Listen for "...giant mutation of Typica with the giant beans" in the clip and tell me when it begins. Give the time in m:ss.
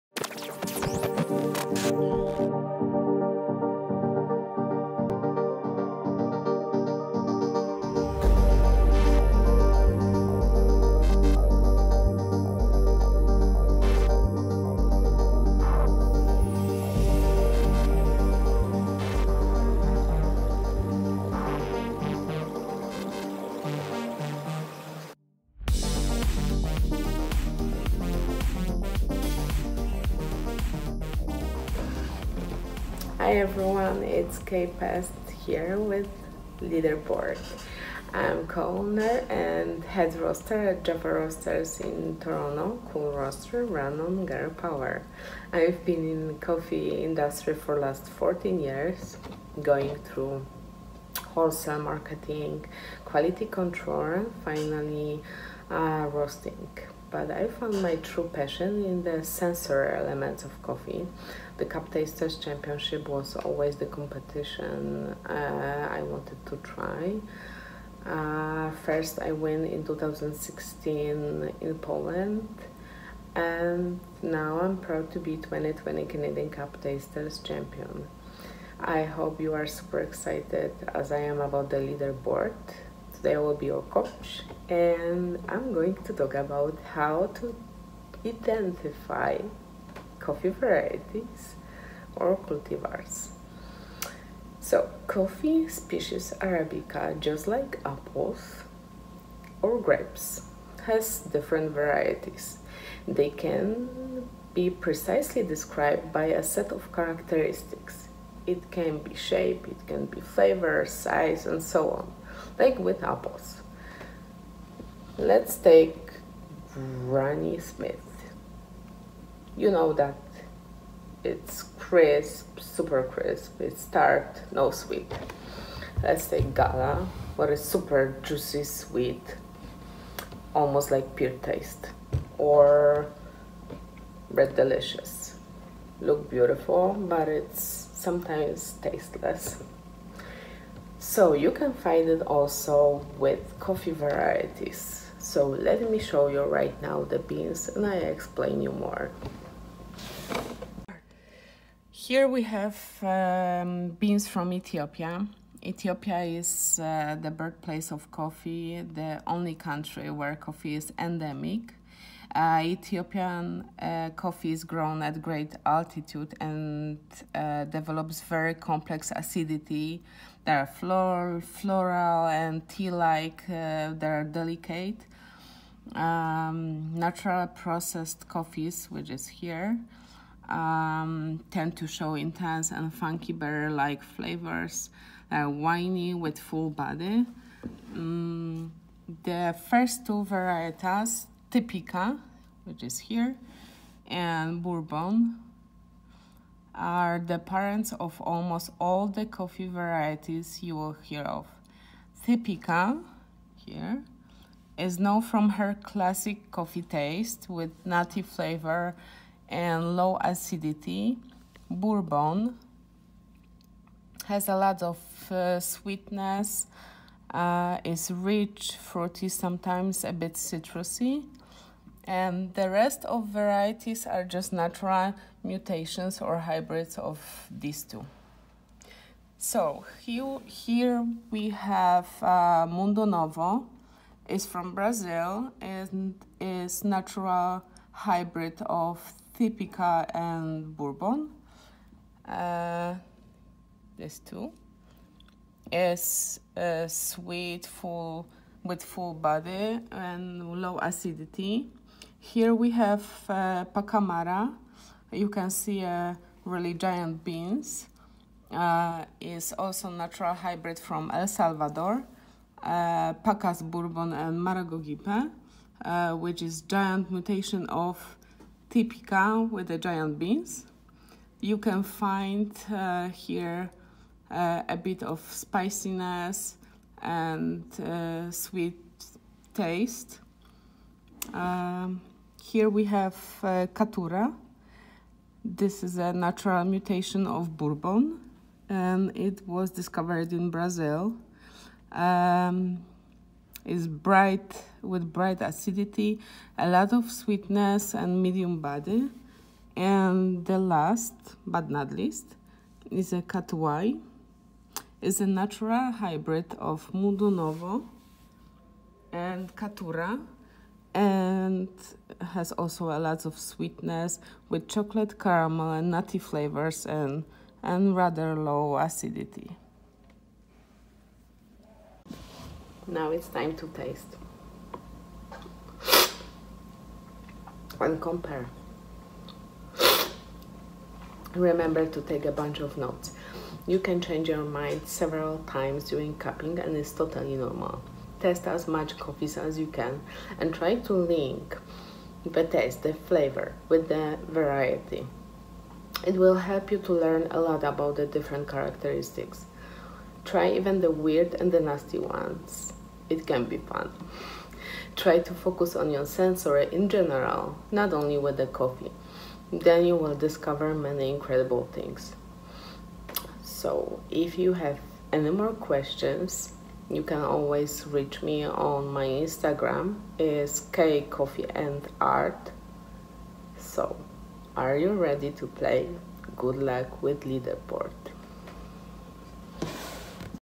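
4:26.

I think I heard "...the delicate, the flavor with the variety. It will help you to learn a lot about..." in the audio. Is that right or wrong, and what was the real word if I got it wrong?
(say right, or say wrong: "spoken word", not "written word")
wrong: "taste", not "delicate".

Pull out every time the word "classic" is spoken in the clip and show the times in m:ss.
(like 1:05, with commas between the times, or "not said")
3:25.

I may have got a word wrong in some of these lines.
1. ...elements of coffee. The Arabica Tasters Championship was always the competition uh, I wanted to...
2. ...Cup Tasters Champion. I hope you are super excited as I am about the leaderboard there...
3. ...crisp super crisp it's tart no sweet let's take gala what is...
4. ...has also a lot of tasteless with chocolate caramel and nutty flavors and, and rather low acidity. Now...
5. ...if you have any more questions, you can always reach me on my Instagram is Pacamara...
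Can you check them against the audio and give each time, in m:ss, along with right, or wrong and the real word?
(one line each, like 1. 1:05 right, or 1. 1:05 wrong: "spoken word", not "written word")
1. 0:59 wrong: "Cup", not "Arabica"
2. 1:16 right
3. 2:01 right
4. 5:12 wrong: "sweetness", not "tasteless"
5. 6:04 wrong: "Kay", not "Pacamara".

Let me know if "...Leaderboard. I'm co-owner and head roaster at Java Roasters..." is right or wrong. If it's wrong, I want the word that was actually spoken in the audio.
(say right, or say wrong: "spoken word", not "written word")
right.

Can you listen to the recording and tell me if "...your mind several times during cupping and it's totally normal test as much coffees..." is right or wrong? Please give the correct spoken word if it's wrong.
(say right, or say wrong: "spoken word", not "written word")
right.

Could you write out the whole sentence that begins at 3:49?
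So here, we have uh, Mundo Novo, is from Brazil and is natural hybrid of Typica and Bourbon.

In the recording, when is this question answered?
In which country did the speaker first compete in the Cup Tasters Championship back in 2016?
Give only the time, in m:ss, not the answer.
1:11.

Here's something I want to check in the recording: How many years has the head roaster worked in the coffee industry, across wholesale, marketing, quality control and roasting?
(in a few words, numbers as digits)
14.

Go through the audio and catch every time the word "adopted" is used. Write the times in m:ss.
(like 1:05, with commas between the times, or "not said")
not said.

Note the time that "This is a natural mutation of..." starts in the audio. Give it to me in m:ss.
4:45.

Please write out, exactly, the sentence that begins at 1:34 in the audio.
So coffee species Arabica just like apples or grapes has different varieties.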